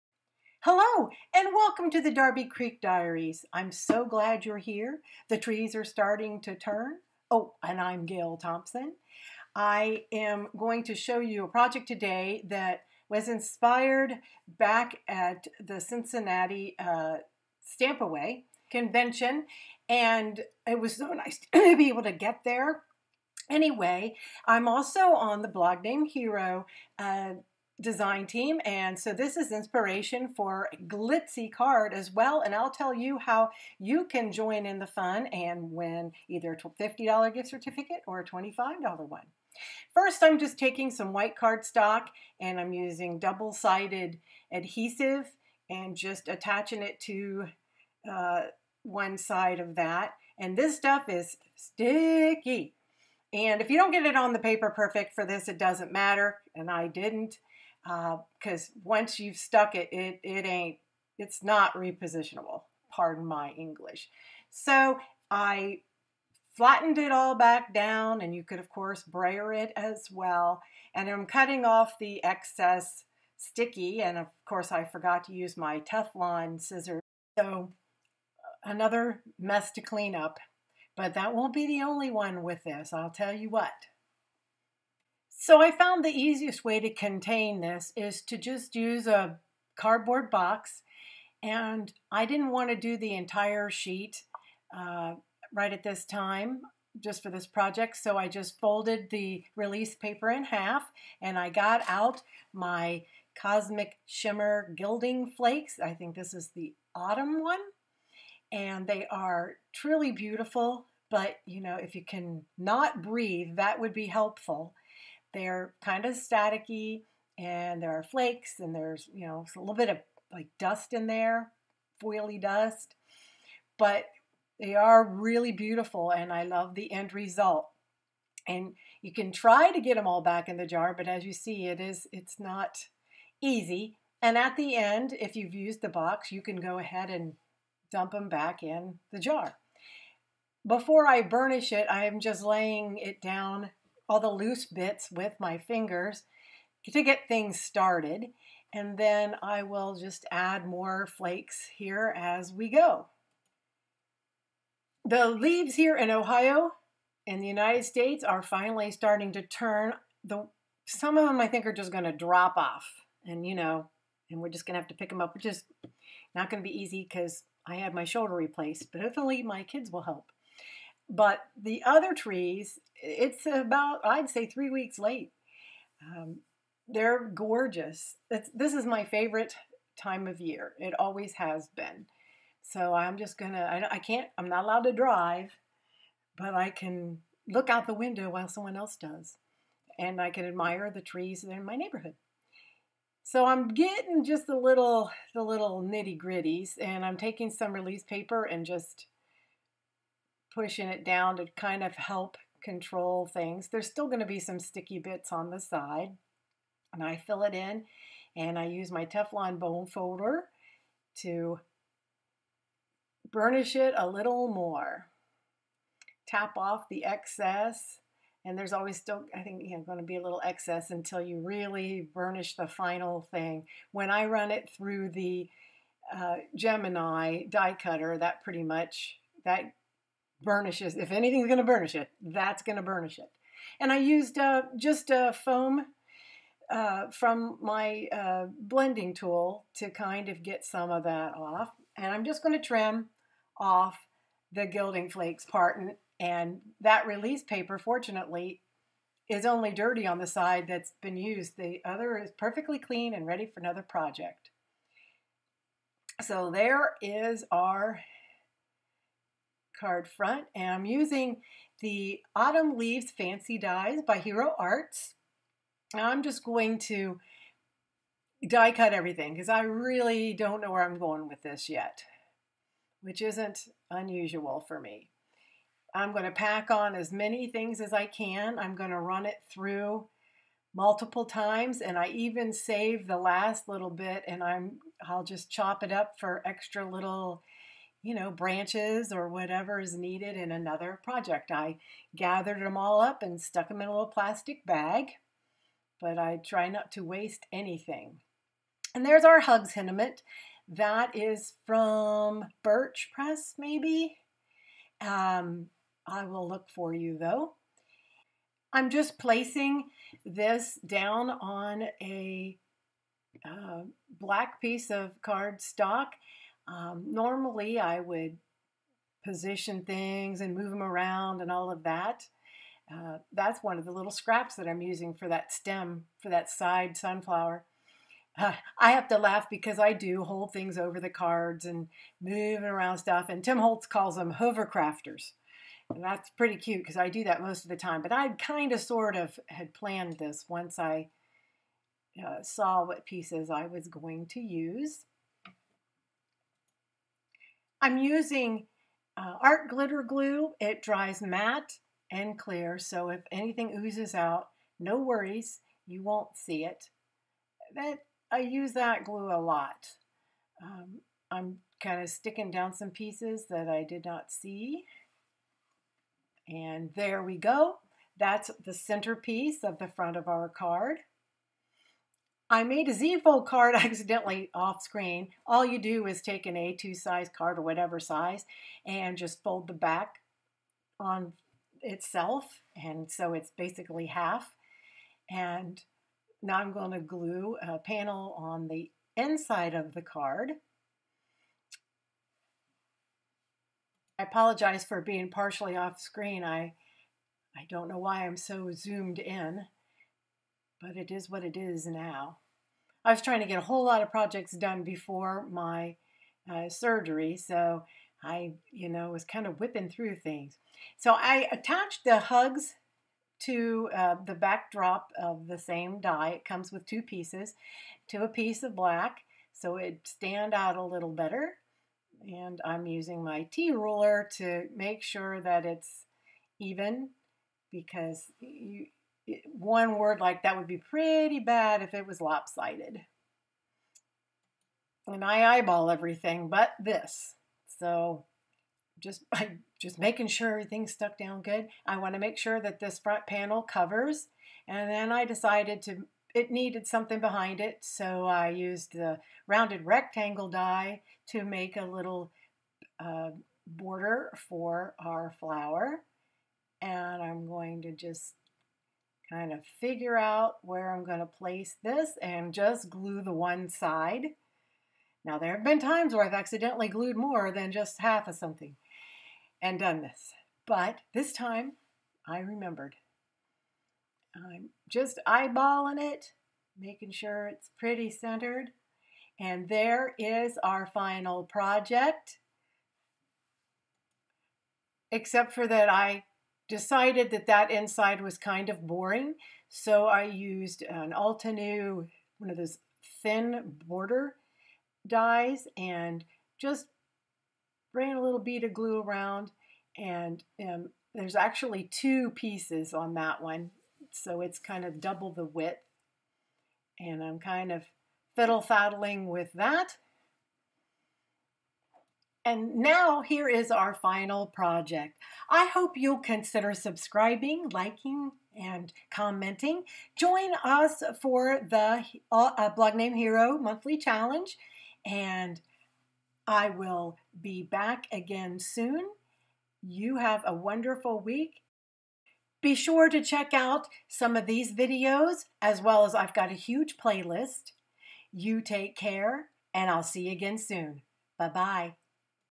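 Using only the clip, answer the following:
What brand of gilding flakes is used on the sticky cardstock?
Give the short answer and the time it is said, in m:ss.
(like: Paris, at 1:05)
Cosmic Shimmer, at 1:43.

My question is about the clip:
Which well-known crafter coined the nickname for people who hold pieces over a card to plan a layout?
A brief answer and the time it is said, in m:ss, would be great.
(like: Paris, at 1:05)
Tim Holtz, at 5:33.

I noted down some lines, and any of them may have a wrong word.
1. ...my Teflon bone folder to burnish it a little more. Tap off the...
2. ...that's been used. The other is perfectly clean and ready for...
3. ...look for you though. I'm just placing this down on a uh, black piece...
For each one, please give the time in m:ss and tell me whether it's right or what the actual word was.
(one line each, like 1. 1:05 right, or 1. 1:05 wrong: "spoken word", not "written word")
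1. 3:28 right
2. 4:10 right
3. 5:06 right.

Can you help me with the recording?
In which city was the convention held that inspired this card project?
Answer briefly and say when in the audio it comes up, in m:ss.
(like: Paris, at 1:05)
Cincinnati, at 0:15.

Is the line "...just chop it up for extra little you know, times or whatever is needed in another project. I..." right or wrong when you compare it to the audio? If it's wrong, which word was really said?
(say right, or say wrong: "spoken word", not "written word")
wrong: "branches", not "times".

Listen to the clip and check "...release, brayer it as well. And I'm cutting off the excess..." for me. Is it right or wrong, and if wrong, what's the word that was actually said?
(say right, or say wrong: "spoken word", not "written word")
wrong: "course", not "release".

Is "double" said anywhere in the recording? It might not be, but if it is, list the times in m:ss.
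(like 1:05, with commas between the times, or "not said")
0:43, 8:25.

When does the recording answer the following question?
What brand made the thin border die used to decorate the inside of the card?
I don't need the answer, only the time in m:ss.
8:11.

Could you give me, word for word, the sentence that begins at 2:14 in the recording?
And at the end, if you've used the box, you can go ahead and dump them back in the jar.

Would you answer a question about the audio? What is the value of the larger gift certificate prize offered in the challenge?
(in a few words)
$50.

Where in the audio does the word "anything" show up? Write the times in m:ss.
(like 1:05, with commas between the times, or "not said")
3:51, 4:57, 5:53.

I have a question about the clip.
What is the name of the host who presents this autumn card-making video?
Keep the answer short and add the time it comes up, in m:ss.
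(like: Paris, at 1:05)
Gail Thompson, at 0:08.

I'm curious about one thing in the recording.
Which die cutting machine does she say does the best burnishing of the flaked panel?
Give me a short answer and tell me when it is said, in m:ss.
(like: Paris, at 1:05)
Gemini, at 3:46.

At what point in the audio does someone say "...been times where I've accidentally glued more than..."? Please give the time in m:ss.
7:45.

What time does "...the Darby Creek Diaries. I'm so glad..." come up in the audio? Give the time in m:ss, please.
0:02.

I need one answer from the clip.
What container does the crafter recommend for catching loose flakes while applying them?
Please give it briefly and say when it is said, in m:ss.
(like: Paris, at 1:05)
A cardboard box, at 1:29.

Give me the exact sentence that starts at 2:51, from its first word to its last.
But the other trees, it's about, I'd say, three weeks late.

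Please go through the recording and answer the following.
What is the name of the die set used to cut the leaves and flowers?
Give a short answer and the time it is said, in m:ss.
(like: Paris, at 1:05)
Autumn Leaves Fancy Dies, at 4:22.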